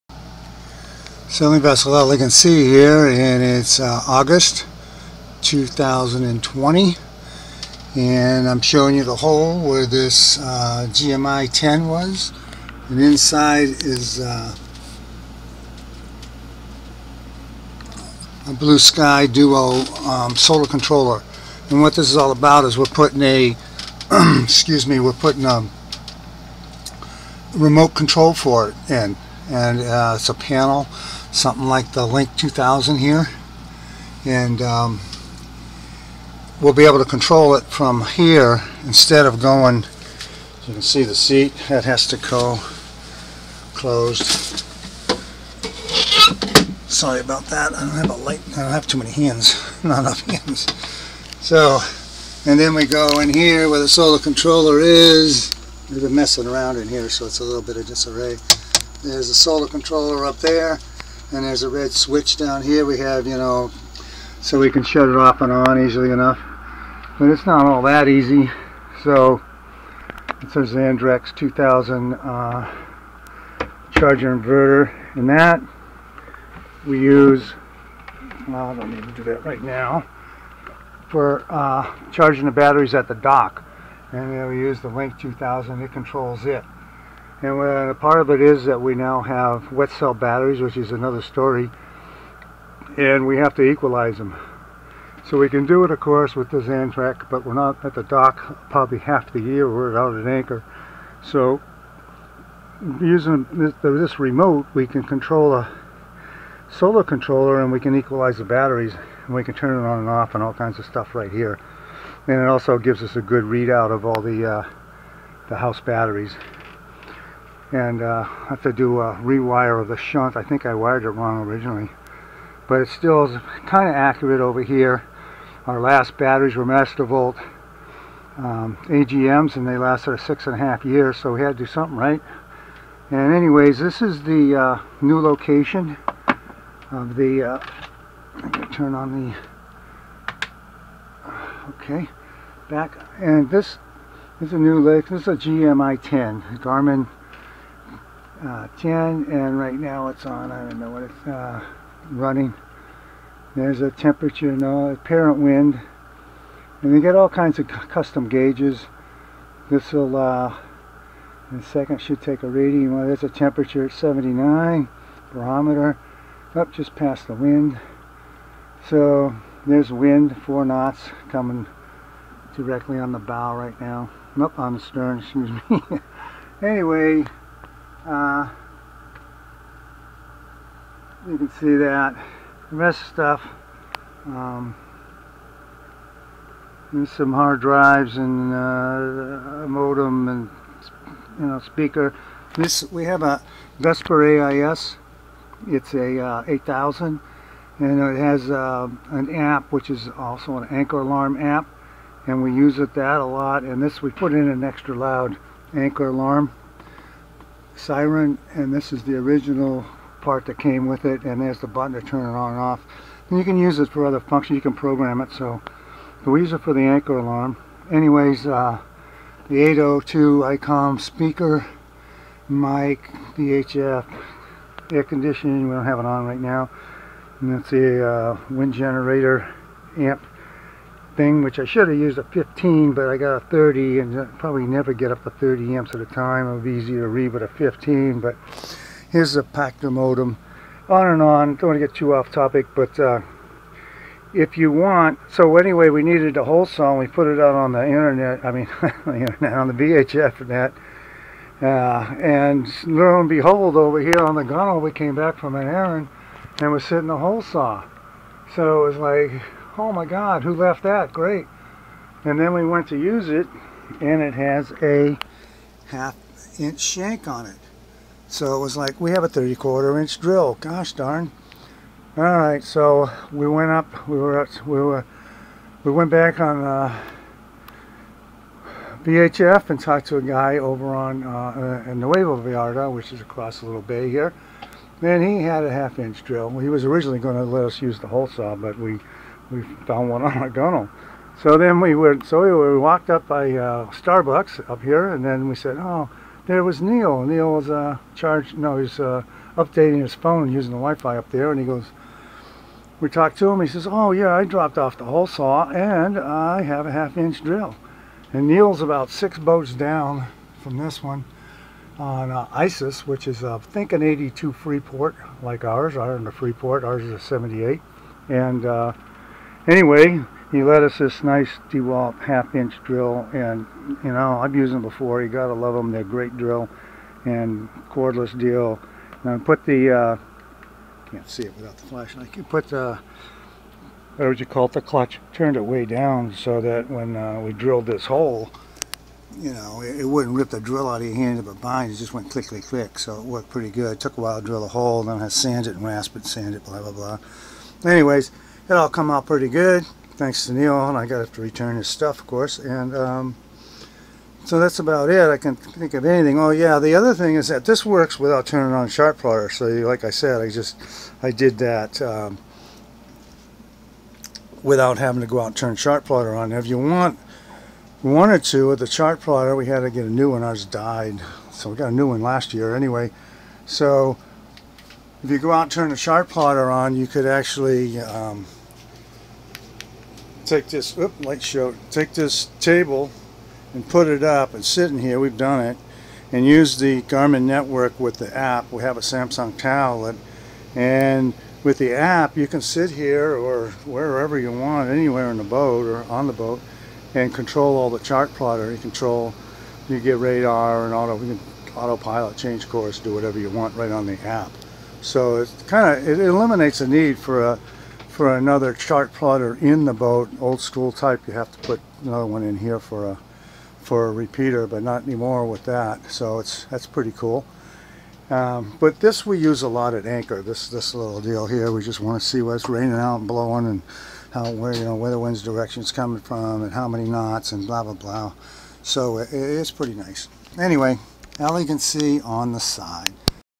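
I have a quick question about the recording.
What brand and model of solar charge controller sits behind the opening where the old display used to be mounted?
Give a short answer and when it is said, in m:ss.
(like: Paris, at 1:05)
Blue Sky Duo, at 0:18.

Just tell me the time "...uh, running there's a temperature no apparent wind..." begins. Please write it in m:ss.
2:31.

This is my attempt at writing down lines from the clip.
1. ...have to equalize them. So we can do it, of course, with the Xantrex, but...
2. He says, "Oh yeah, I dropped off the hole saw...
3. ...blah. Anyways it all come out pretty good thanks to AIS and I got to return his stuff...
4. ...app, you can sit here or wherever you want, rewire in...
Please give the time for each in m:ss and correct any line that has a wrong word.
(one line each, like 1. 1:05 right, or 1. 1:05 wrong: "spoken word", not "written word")
1. 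1:33 right
2. 5:03 right
3. 5:46 wrong: "Neil", not "AIS"
4. 6:31 wrong: "anywhere", not "rewire".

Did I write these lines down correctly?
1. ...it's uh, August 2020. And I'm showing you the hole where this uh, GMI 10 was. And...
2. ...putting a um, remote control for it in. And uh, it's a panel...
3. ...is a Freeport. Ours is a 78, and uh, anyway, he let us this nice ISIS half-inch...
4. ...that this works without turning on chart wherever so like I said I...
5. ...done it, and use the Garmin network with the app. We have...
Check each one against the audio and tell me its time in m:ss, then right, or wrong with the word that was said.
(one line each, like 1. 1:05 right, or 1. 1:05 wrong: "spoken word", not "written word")
1. 0:03 right
2. 0:25 right
3. 5:16 wrong: "DeWalt", not "ISIS"
4. 5:57 wrong: "plotter", not "wherever"
5. 6:25 right.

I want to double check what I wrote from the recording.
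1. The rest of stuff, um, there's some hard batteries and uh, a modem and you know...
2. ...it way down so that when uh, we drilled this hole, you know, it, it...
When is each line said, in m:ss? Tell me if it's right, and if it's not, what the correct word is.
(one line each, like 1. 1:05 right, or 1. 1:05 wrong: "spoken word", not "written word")
1. 3:02 wrong: "drives", not "batteries"
2. 5:35 right.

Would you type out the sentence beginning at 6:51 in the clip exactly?
You have to put another one in here for a for a repeater, but not anymore with that.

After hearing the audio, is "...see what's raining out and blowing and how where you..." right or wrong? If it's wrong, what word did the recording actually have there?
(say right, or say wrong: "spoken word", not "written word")
right.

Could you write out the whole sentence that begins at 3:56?
It would be easier to read with a 15, but here's the Pactor modem.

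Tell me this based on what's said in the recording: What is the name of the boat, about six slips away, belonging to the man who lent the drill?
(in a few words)
ISIS.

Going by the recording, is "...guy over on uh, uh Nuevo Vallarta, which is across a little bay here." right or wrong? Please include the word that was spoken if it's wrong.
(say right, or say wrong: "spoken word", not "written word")
right.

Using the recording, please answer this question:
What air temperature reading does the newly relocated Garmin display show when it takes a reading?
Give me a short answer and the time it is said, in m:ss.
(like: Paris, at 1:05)
79, at 2:43.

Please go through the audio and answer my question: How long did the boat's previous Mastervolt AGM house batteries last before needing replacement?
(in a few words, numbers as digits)
6 and a half years.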